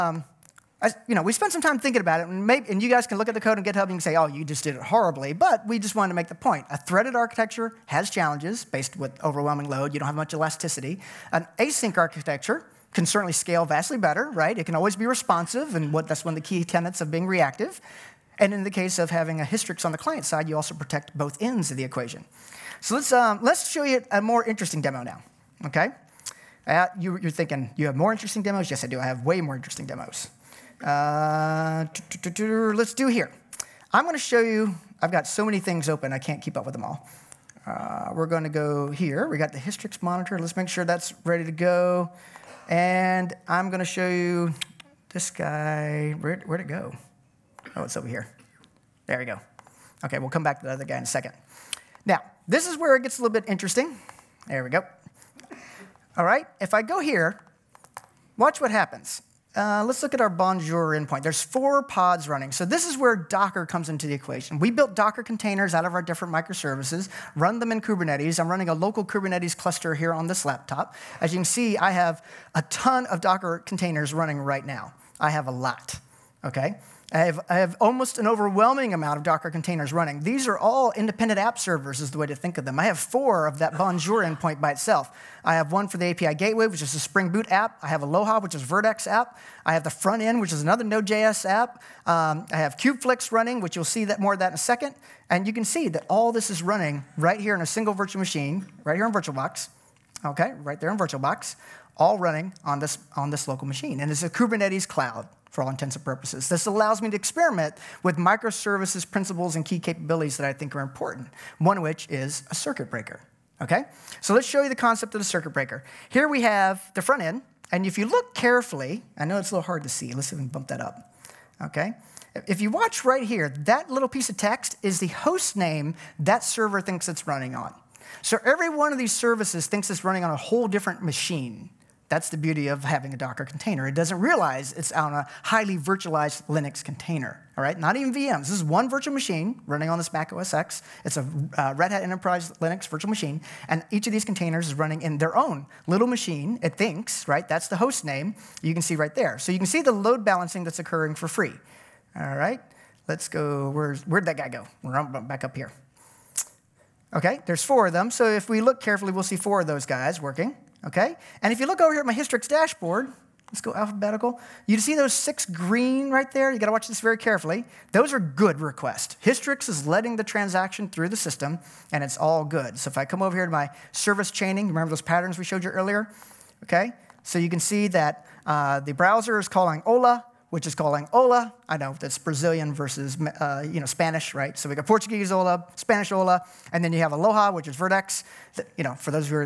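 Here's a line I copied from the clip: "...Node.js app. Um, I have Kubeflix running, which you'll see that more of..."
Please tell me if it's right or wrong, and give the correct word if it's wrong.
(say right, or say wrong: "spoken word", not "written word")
right.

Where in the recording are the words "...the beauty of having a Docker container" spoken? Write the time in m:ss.
2:12.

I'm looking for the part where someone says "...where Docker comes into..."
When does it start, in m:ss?
1:02.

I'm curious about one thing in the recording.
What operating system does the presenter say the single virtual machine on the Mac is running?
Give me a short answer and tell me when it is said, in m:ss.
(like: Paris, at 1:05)
Red Hat Enterprise Linux, at 2:21.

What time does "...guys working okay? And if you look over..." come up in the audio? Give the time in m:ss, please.
2:39.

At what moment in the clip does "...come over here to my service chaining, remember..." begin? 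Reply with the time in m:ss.
2:53.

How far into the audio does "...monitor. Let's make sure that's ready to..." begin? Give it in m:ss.
0:40.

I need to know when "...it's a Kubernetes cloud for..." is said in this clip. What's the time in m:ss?
1:44.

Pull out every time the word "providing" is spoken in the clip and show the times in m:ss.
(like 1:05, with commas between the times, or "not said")
not said.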